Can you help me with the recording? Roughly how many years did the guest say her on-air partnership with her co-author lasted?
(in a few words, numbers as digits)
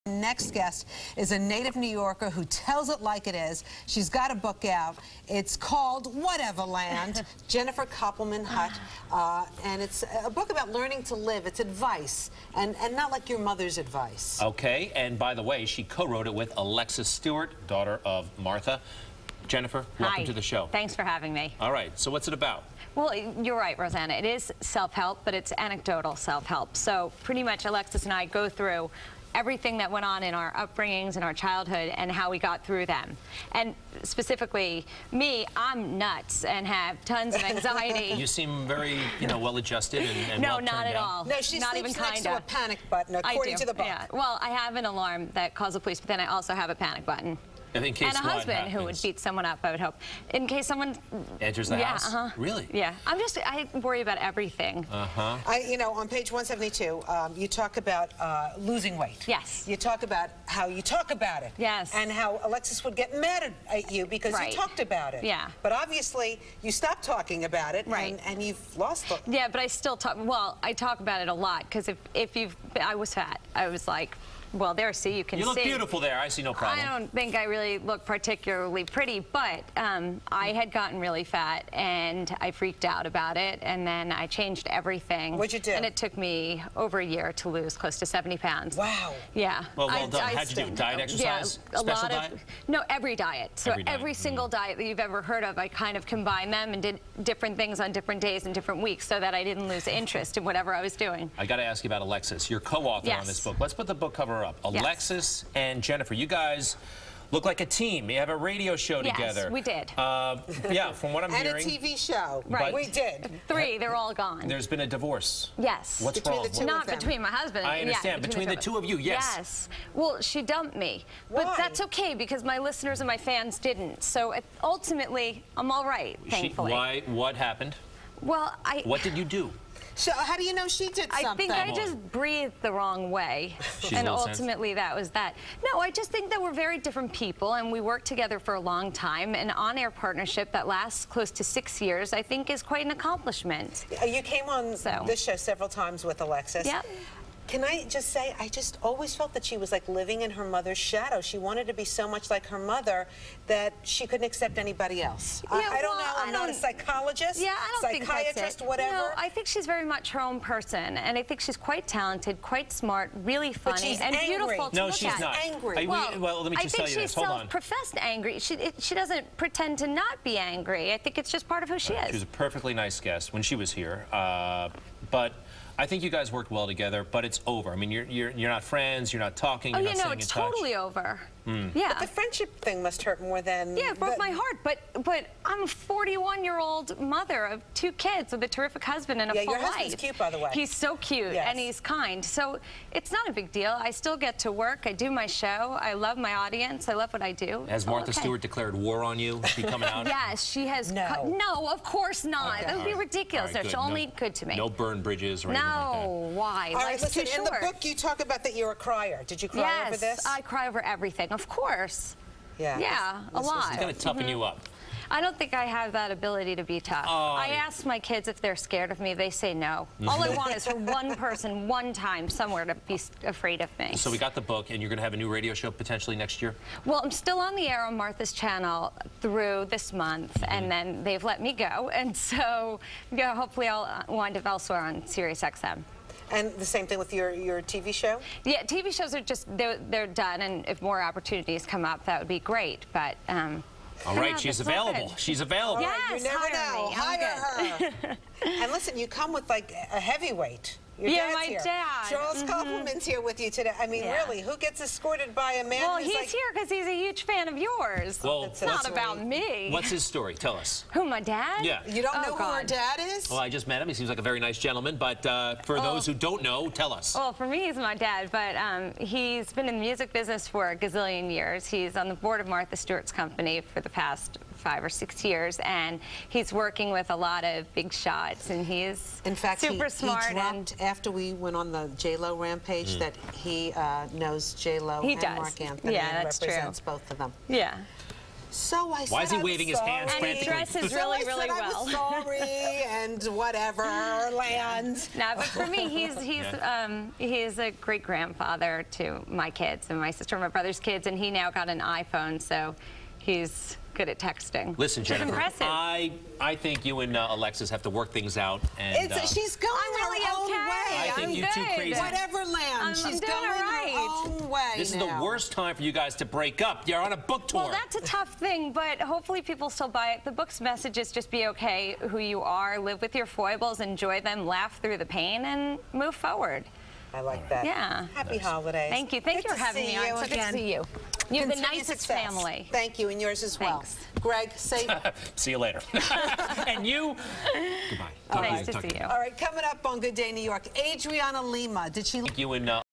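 6.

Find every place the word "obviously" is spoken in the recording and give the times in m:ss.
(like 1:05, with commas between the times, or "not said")
1:05.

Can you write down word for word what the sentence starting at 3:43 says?
So we got the book, and you're going to have a new radio show potentially next year?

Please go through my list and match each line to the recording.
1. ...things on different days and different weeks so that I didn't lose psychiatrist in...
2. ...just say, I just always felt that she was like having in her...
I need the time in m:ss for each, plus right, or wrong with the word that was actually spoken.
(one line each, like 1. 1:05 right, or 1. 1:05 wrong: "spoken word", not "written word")
1. 1:37 wrong: "interest", not "psychiatrist"
2. 2:27 wrong: "living", not "having".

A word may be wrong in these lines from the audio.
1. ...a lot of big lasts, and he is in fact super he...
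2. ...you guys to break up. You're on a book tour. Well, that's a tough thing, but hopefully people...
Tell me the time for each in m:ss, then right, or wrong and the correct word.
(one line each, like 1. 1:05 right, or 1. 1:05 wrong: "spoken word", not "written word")
1. 4:37 wrong: "shots", not "lasts"
2. 5:15 right.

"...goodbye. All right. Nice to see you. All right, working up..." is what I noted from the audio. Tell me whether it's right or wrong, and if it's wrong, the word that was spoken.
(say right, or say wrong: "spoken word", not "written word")
wrong: "coming", not "working".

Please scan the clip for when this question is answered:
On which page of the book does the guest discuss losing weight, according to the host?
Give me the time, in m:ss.
0:56.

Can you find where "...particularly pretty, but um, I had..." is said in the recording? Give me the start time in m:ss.
1:18.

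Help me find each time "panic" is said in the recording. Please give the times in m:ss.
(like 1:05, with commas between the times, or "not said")
0:42, 0:46.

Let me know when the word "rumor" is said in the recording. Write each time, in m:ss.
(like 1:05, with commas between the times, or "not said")
not said.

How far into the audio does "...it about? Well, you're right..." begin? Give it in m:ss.
0:22.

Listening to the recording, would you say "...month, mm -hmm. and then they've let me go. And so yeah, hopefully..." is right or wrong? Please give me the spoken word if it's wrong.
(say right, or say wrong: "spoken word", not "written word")
right.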